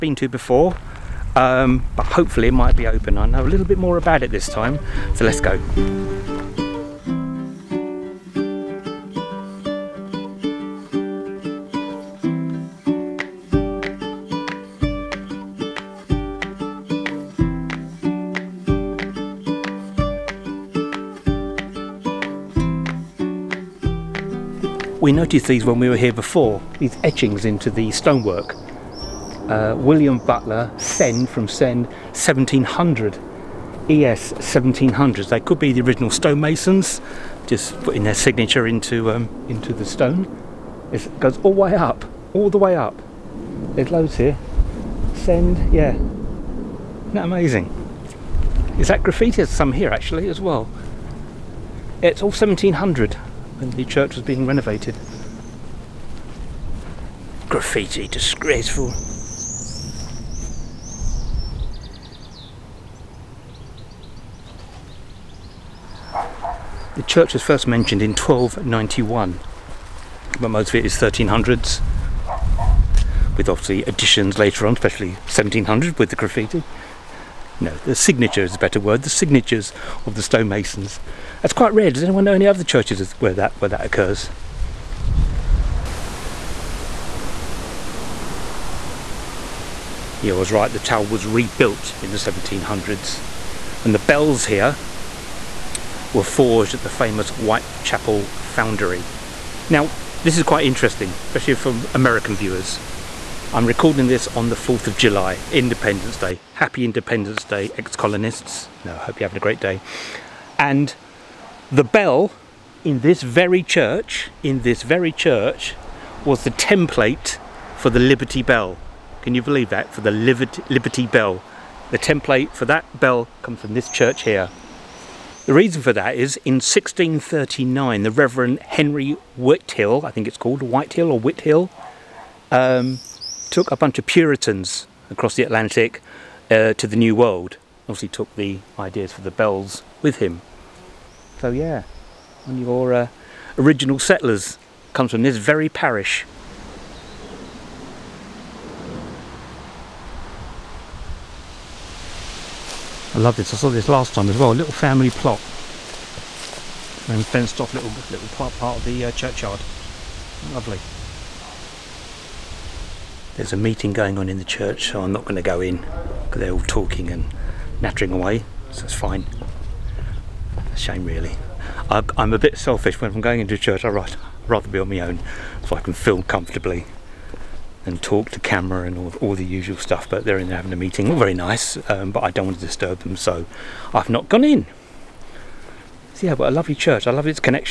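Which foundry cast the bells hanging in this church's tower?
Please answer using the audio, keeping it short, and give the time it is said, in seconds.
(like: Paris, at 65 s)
Whitechapel Foundry, at 97 s.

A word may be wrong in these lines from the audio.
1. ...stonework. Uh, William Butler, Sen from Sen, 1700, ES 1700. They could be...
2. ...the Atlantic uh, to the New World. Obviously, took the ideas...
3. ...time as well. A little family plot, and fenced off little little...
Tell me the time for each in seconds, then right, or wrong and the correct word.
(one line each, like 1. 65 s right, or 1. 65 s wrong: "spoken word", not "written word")
1. 27 s right
2. 135 s right
3. 154 s right.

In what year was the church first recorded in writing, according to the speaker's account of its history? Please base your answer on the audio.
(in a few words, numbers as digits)
1291.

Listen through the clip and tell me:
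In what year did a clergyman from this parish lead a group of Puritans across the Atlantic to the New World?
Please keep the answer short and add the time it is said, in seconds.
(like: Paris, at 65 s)
1639, at 126 s.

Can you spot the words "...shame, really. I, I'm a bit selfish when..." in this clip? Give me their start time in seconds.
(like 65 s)
170 s.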